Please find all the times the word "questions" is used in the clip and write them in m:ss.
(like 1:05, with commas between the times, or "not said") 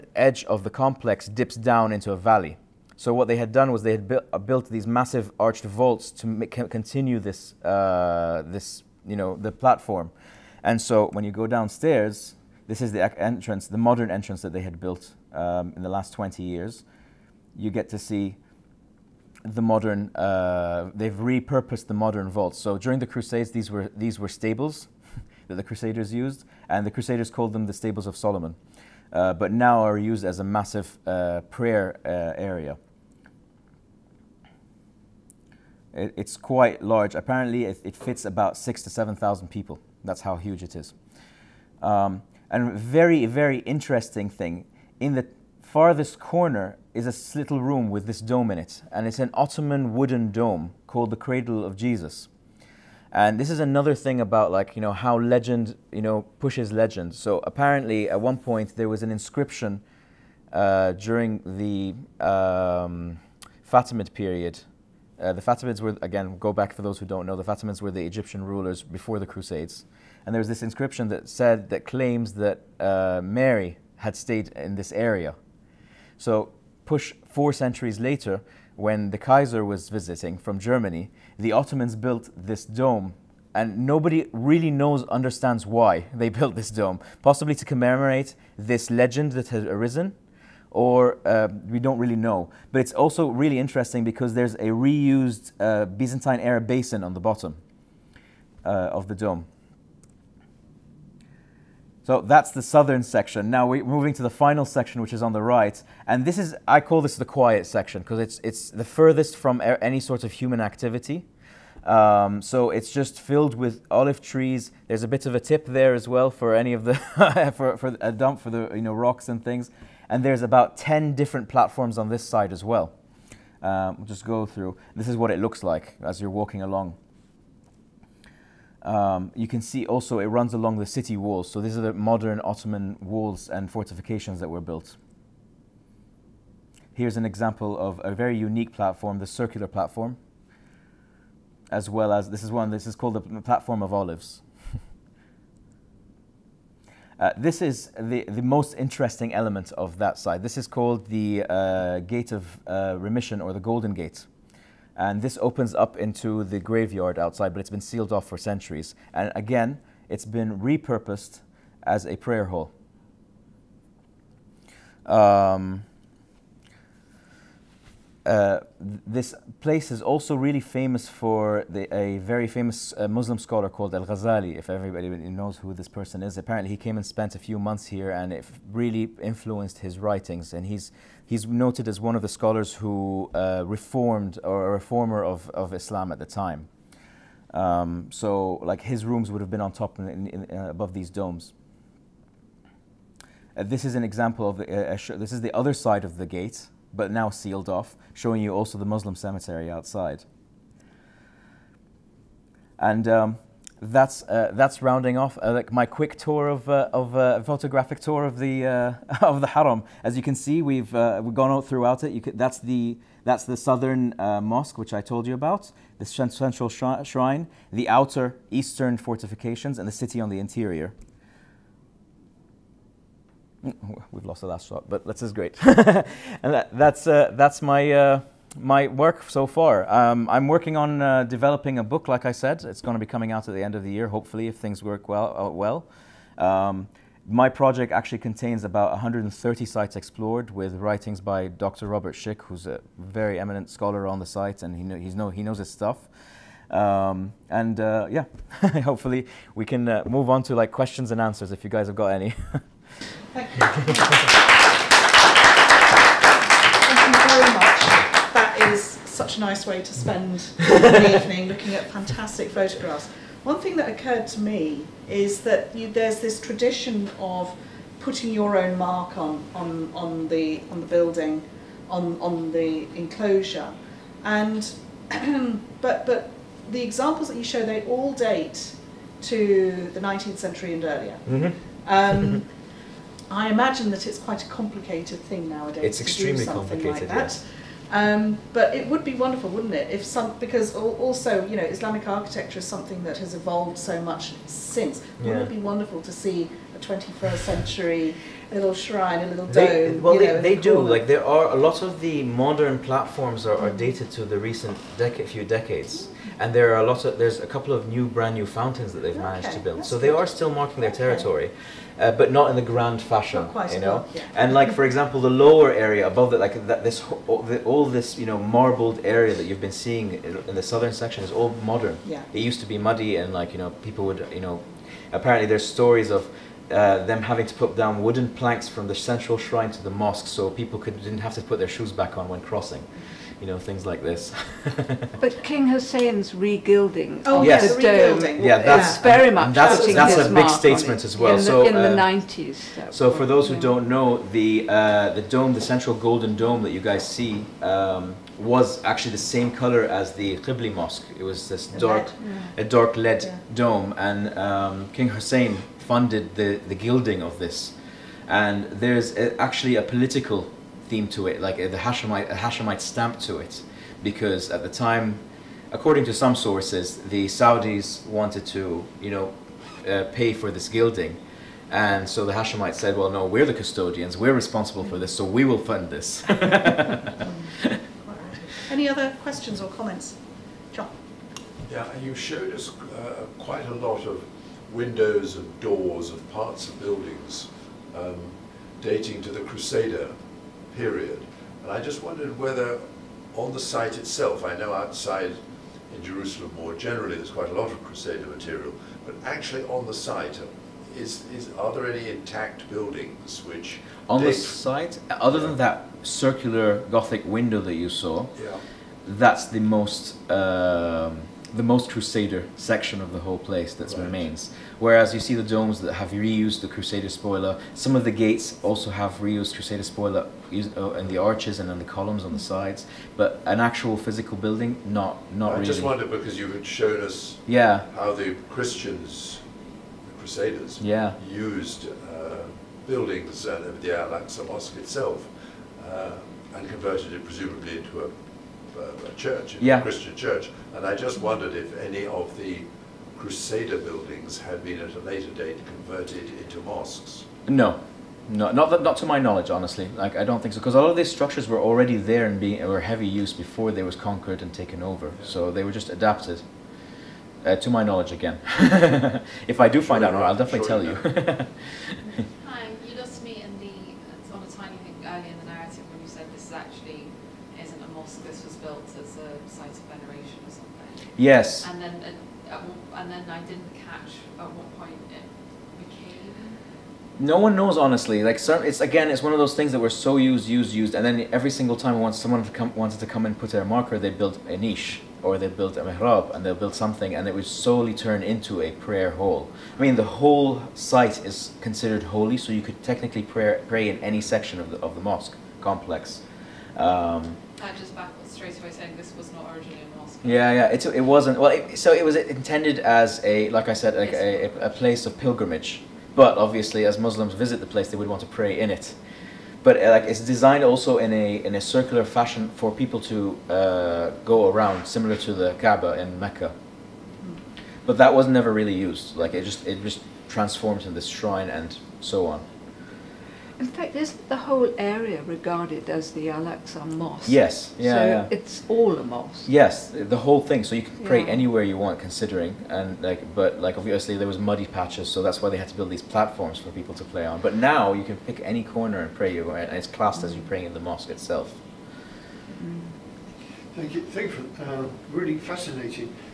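4:10, 6:19.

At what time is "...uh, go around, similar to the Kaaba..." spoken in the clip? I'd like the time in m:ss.
8:33.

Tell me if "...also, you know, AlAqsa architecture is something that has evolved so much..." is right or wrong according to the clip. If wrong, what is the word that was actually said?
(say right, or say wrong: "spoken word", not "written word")
wrong: "Islamic", not "AlAqsa".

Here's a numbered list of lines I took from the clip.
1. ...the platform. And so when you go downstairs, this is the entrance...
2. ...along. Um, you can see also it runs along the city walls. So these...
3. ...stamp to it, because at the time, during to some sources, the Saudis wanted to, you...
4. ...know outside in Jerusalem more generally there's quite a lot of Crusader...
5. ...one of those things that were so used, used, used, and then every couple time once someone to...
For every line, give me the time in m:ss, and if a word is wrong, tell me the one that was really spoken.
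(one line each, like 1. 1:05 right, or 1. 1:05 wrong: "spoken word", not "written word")
1. 0:09 right
2. 2:06 right
3. 6:02 wrong: "according", not "during"
4. 6:34 right
5. 7:59 wrong: "single", not "couple".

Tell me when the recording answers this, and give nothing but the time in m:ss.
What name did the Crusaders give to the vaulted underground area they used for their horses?
0:27.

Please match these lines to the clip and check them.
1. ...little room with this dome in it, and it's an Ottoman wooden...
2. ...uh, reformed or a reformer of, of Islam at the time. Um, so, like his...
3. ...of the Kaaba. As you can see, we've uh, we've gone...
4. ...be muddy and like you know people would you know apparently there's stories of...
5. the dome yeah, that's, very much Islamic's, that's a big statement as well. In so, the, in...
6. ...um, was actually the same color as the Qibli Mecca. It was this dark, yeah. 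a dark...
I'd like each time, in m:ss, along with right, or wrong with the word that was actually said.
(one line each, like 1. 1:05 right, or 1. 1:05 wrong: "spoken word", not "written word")
1. 0:47 right
2. 3:03 right
3. 3:29 wrong: "Haram", not "Kaaba"
4. 5:22 right
5. 5:37 wrong: "That", not "Islamic"
6. 5:47 wrong: "Mosque", not "Mecca".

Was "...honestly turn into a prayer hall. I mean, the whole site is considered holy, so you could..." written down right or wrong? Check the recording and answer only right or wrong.
wrong.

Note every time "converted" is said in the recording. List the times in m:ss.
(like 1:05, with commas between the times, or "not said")
7:16, 7:25.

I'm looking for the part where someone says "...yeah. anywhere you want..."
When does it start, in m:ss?
8:51.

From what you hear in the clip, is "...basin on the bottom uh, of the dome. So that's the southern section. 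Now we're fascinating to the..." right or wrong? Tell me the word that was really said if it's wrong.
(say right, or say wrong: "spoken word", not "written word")
wrong: "moving", not "fascinating".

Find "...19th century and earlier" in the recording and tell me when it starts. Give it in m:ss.
4:39.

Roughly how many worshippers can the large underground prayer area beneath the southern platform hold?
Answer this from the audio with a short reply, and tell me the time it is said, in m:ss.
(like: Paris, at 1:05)
6,000 to 7,000, at 0:38.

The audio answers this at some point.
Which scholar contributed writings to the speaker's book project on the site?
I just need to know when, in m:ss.
4:01.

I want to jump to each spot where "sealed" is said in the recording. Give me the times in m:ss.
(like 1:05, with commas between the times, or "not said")
2:37, 3:17.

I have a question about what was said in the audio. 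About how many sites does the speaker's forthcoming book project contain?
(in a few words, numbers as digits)
130.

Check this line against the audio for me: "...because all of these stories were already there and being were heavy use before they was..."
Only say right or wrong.
wrong.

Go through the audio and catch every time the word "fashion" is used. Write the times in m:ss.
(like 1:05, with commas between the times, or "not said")
5:13, 8:32.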